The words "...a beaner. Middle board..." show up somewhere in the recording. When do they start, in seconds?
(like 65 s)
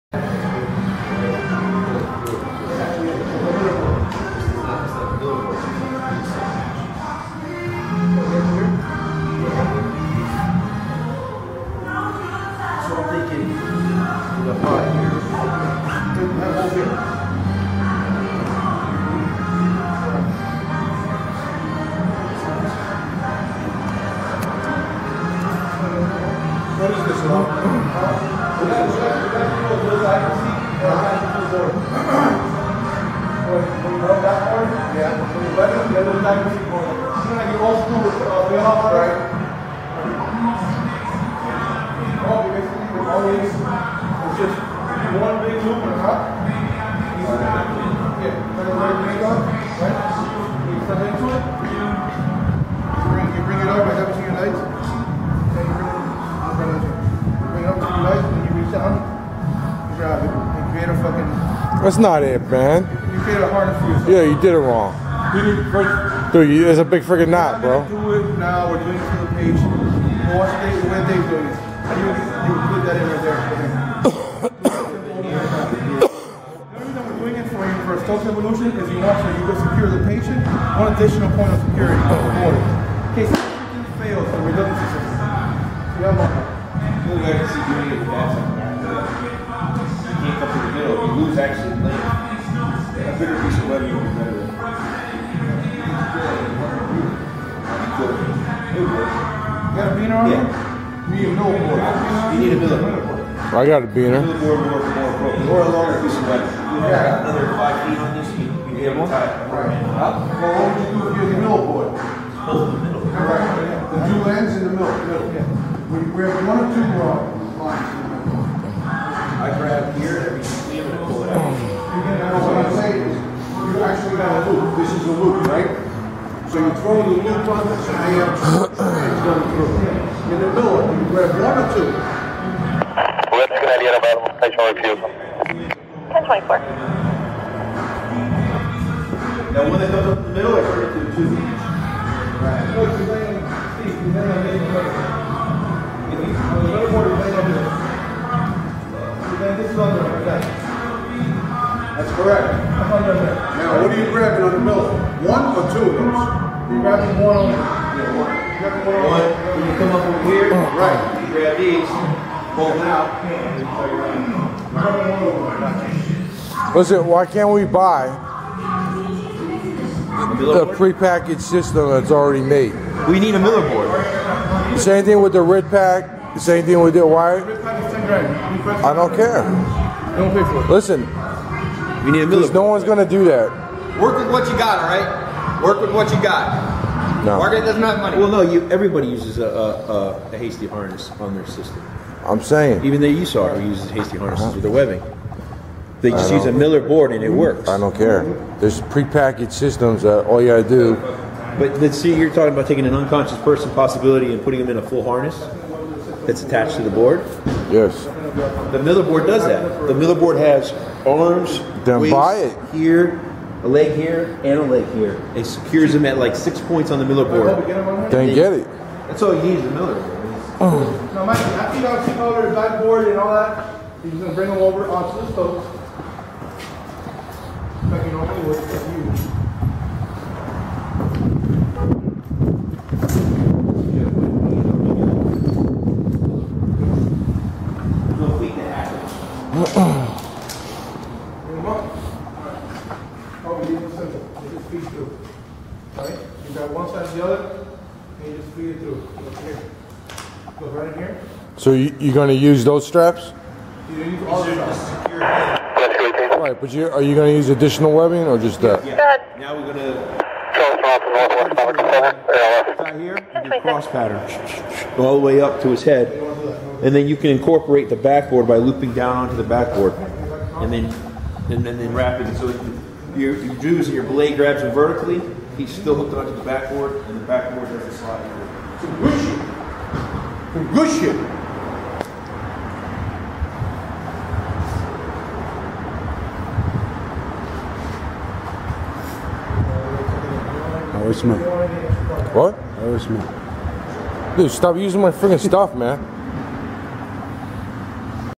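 103 s.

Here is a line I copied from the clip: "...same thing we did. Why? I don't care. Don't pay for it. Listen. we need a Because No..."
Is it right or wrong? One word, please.
right.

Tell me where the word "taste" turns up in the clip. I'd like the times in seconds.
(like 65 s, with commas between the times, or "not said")
not said.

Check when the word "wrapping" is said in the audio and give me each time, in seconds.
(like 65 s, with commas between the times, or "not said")
271 s.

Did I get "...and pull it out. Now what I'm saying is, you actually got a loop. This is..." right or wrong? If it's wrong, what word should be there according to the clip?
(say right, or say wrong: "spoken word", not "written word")
right.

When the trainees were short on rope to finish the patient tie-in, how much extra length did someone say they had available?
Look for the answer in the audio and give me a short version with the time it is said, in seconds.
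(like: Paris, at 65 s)
5 feet, at 107 s.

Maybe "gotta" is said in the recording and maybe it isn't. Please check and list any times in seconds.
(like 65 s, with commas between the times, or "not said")
200 s.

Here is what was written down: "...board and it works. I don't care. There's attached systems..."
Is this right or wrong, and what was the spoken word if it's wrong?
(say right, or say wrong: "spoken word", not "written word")
wrong: "prepackaged", not "attached".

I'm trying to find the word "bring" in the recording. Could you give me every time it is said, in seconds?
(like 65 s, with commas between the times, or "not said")
224 s.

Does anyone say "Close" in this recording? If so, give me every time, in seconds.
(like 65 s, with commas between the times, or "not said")
111 s.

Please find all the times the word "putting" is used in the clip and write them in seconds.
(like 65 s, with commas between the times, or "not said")
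204 s.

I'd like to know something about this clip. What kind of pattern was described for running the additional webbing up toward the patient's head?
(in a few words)
cross pattern.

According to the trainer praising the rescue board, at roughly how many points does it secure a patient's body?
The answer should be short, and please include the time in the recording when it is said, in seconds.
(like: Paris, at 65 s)
6 points, at 216 s.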